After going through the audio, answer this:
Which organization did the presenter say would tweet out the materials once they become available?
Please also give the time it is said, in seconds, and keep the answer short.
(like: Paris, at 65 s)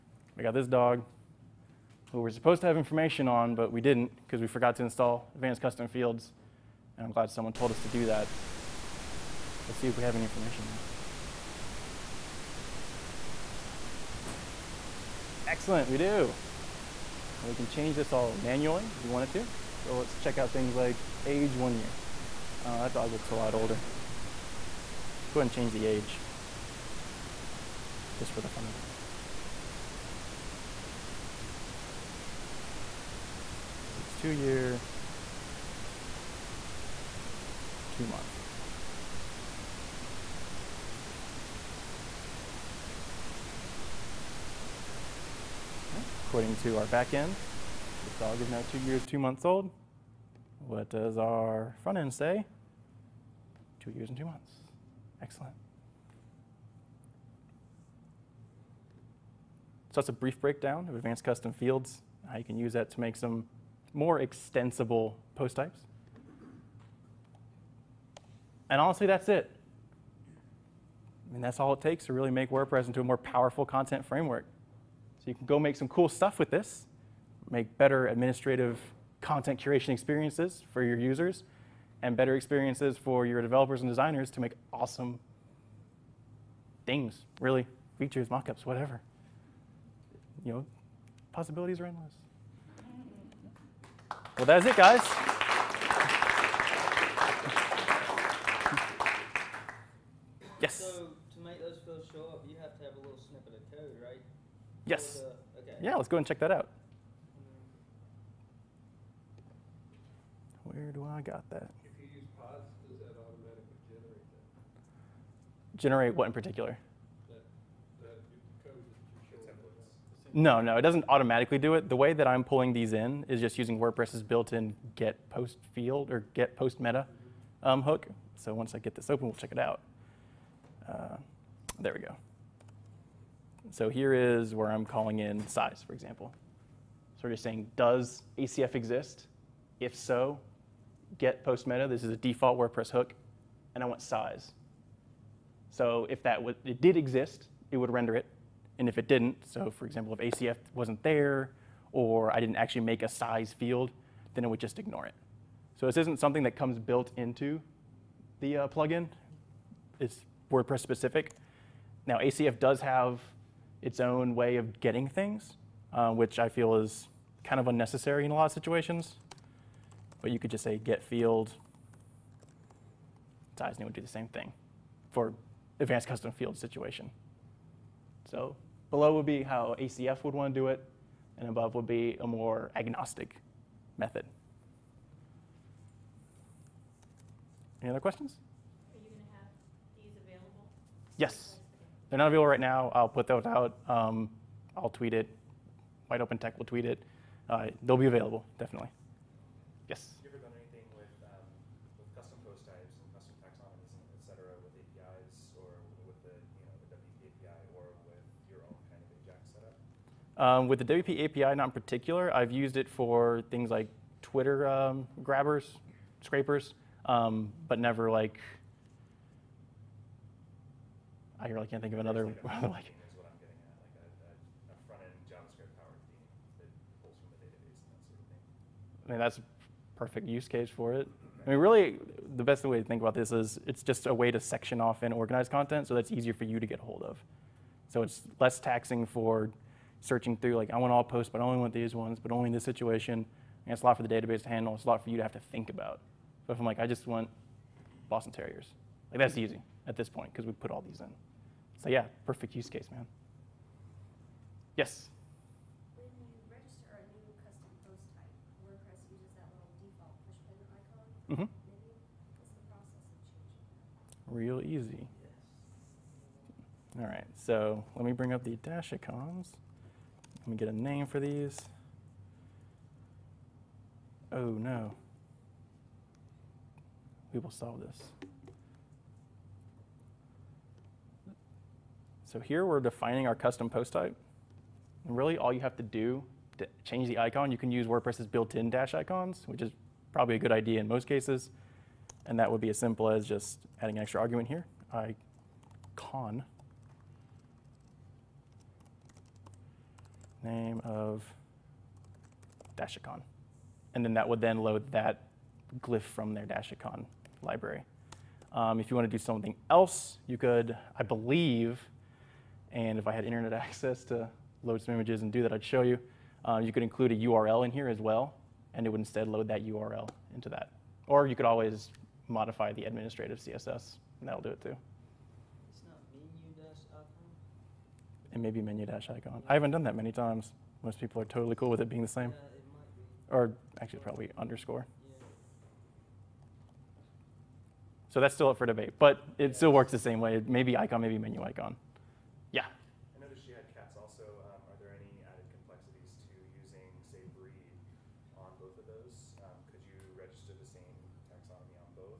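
Wide Open Tech, at 196 s.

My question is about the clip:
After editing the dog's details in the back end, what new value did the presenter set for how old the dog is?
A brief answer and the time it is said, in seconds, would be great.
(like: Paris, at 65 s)
2 years, 2 months, at 34 s.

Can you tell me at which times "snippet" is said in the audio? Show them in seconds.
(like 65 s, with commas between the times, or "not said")
103 s.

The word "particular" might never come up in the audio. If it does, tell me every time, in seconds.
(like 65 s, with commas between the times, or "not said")
116 s, 211 s.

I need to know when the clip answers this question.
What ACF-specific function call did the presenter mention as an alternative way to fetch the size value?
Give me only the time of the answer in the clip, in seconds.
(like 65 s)
170 s.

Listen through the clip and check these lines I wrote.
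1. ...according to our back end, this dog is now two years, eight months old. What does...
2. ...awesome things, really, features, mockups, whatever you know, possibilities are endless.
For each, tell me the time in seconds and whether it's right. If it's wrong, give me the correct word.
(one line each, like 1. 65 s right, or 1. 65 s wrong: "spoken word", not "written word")
1. 46 s wrong: "two", not "eight"
2. 84 s right.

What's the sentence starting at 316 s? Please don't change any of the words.
Uh, you could include a URL in here as well, and it would instead load that URL into that.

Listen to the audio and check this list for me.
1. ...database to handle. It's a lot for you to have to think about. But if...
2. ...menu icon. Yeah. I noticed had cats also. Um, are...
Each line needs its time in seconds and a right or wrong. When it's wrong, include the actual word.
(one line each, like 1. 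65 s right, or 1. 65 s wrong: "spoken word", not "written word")
1. 244 s right
2. 341 s right.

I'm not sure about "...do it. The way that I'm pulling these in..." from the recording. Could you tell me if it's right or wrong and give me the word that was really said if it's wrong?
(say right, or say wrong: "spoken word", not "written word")
right.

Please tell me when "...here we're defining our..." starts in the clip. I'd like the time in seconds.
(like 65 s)
282 s.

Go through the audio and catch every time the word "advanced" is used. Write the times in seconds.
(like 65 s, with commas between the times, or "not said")
5 s, 60 s, 175 s.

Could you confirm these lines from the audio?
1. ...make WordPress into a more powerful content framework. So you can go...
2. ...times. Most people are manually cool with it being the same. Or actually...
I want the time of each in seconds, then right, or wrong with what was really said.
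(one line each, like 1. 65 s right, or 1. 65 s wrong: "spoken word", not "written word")
1. 72 s right
2. 330 s wrong: "totally", not "manually".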